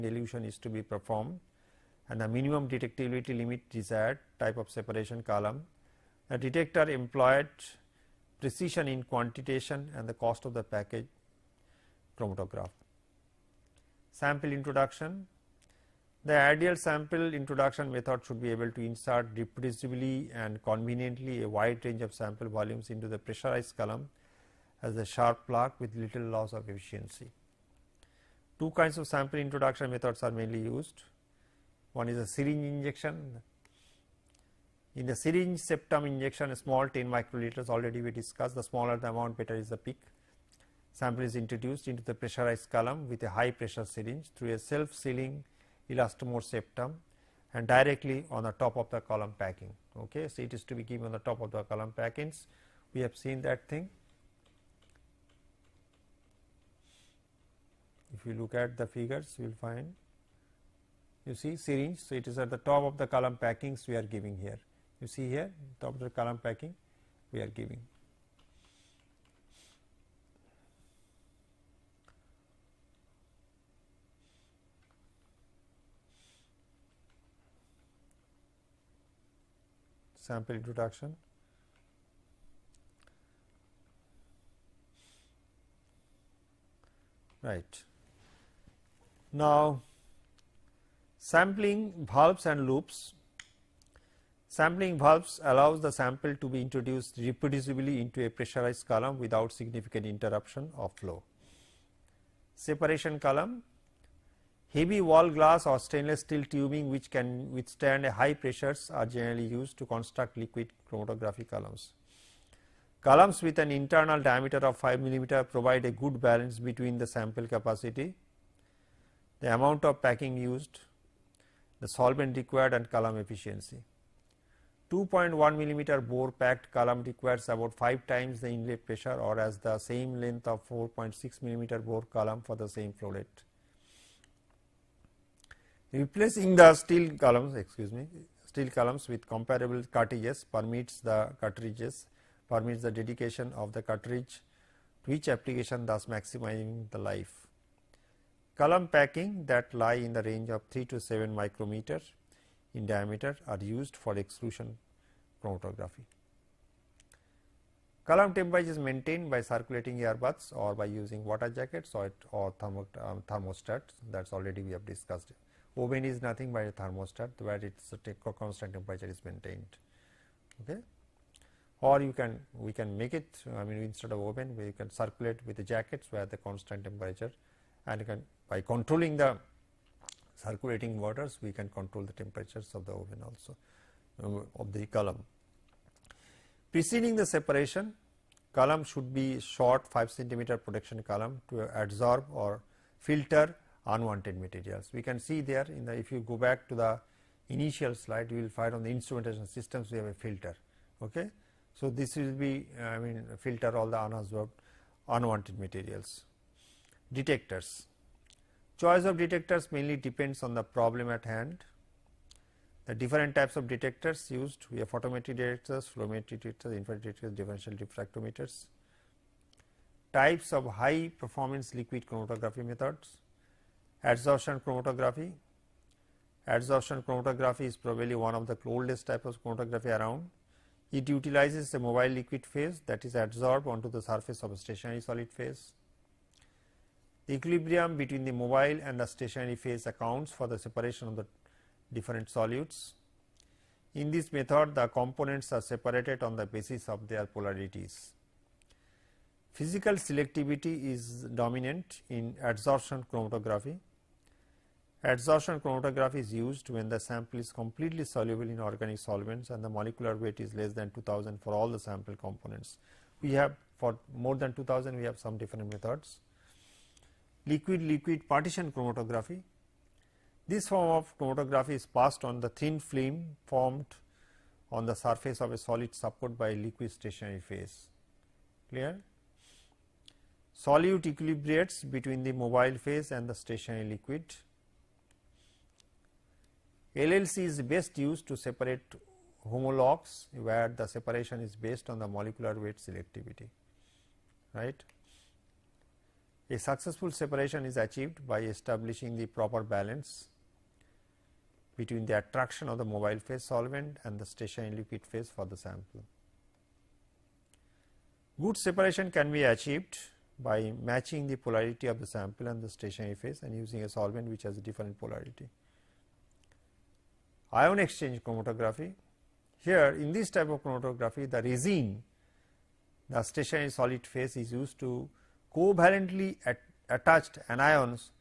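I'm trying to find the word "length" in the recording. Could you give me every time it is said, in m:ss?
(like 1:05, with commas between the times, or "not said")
2:10.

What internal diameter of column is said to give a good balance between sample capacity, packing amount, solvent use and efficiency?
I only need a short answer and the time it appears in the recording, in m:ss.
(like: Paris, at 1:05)
5 millimeter, at 1:54.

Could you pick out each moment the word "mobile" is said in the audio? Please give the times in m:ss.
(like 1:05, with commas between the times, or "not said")
3:51, 3:58, 4:42, 5:02.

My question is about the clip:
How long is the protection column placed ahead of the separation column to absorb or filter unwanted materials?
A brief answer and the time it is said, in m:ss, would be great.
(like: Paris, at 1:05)
5 centimeters, at 3:09.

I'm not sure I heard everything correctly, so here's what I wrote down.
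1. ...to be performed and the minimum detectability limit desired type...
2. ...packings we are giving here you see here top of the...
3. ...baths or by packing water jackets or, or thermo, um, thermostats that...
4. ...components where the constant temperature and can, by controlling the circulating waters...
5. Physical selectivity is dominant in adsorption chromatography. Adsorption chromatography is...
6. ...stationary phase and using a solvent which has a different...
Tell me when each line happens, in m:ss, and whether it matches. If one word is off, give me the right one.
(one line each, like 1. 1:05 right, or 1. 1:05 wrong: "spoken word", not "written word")
1. 0:00 right
2. 1:03 right
3. 2:40 wrong: "using", not "packing"
4. 2:55 wrong: "jackets", not "components"
5. 4:09 right
6. 5:12 right.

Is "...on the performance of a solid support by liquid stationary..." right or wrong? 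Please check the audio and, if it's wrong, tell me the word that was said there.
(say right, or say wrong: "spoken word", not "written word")
wrong: "surface", not "performance".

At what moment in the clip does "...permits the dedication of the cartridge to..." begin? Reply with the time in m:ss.
2:22.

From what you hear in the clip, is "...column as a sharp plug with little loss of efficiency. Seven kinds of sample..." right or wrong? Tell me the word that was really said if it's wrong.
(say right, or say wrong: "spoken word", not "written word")
wrong: "Two", not "Seven".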